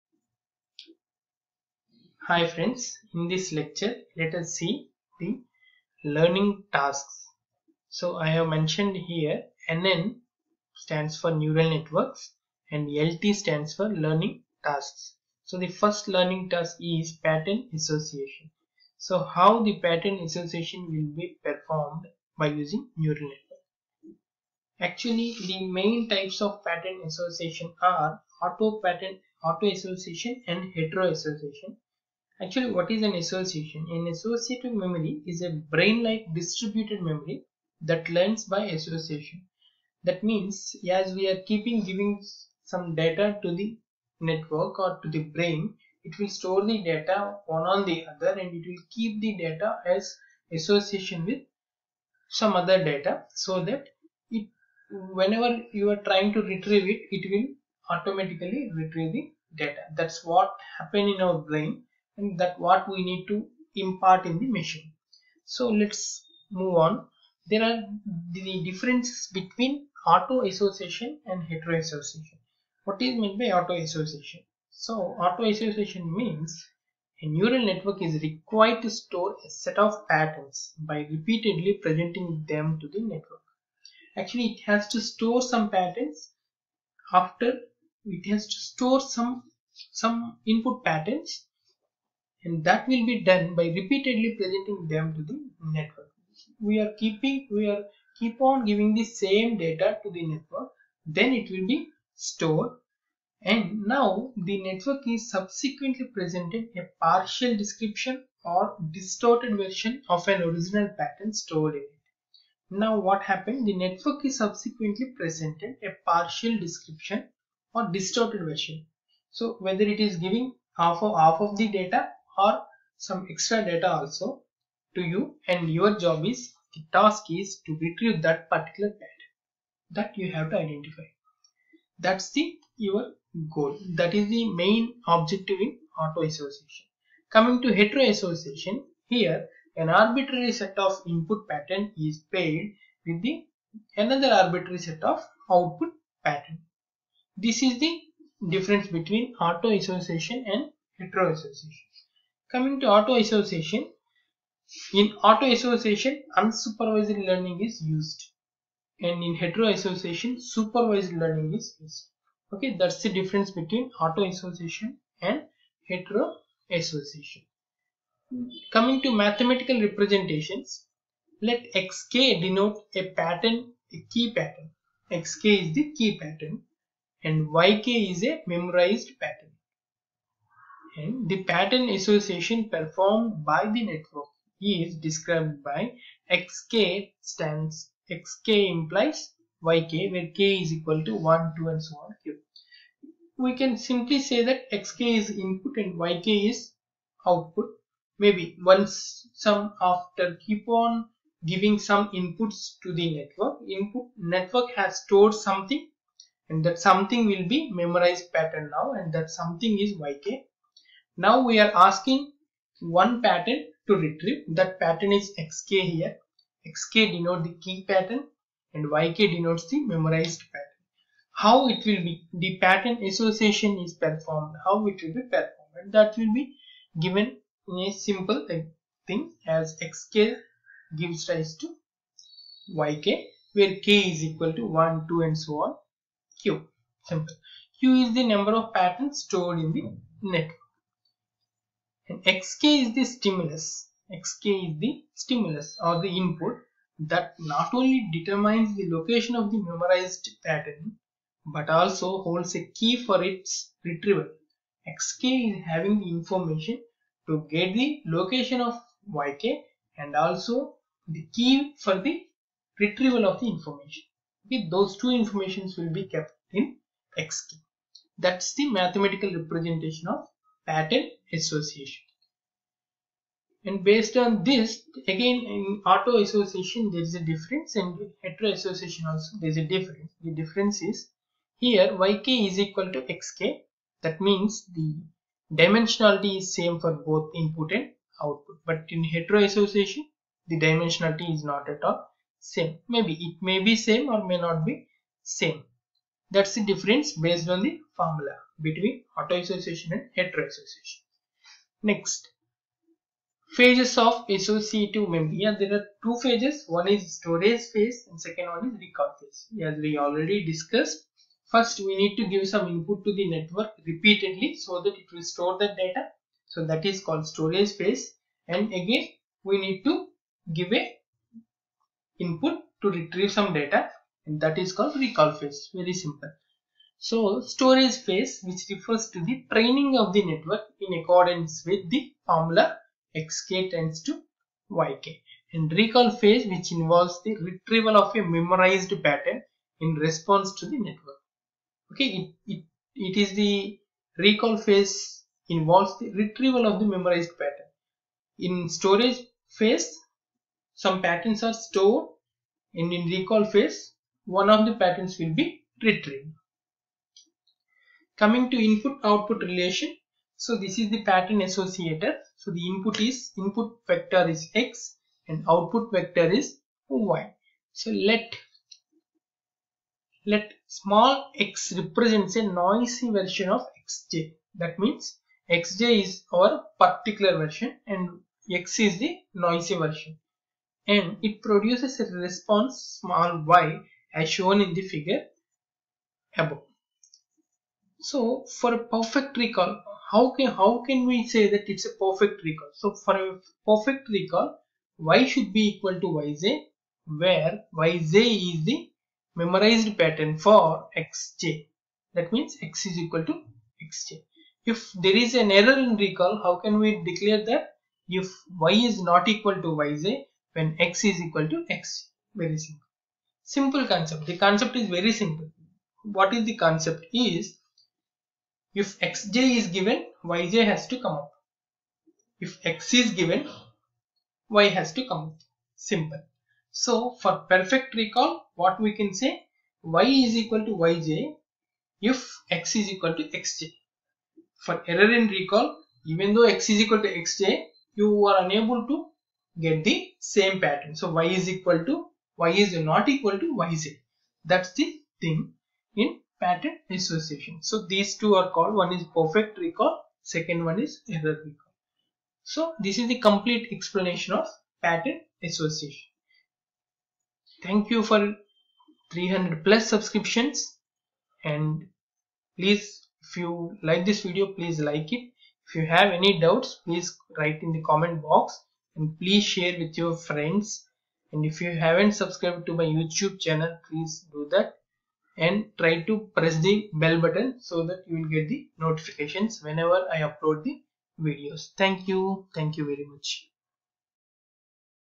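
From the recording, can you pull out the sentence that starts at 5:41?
Okay, it, it, it is the recall phase involves the retrieval of the memorized pattern.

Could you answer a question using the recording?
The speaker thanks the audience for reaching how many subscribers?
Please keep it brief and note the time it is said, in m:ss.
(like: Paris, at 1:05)
300 plus, at 7:39.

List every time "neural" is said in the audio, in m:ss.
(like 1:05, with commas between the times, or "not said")
0:11, 0:22, 1:17.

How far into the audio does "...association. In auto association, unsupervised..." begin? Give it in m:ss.
2:33.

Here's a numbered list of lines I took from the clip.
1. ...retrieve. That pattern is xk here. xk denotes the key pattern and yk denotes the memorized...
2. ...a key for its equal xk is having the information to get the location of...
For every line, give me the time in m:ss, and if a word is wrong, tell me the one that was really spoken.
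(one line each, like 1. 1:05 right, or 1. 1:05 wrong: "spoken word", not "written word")
1. 3:33 right
2. 4:12 wrong: "retrieval", not "equal".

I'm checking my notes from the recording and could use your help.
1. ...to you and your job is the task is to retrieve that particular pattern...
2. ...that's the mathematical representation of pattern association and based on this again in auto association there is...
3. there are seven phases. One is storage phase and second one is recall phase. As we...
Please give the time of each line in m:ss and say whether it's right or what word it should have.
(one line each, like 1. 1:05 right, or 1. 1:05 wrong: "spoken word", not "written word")
1. 2:04 right
2. 4:28 right
3. 5:05 wrong: "two", not "seven".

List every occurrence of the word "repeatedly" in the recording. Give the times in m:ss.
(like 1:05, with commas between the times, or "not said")
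1:21, 1:33, 5:13.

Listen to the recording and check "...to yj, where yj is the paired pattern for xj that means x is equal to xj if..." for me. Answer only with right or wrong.
wrong.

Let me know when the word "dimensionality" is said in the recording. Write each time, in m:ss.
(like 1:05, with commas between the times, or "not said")
4:45, 4:50.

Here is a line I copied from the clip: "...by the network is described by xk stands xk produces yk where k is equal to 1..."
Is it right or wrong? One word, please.
wrong.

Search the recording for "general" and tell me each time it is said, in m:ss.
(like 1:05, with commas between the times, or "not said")
not said.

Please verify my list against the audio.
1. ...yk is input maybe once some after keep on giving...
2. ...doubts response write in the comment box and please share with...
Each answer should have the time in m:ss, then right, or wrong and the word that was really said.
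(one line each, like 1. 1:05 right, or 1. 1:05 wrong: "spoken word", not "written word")
1. 3:16 wrong: "output", not "input"
2. 7:46 wrong: "please", not "response".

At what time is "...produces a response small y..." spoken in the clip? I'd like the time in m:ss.
6:21.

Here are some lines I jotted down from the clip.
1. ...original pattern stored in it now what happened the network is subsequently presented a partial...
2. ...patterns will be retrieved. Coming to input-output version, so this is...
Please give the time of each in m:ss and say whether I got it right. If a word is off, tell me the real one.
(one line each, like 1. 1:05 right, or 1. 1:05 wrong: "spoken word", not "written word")
1. 1:50 right
2. 5:54 wrong: "relation", not "version".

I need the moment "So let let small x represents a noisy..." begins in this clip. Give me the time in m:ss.
6:07.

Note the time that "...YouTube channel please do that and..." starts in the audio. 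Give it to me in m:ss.
7:52.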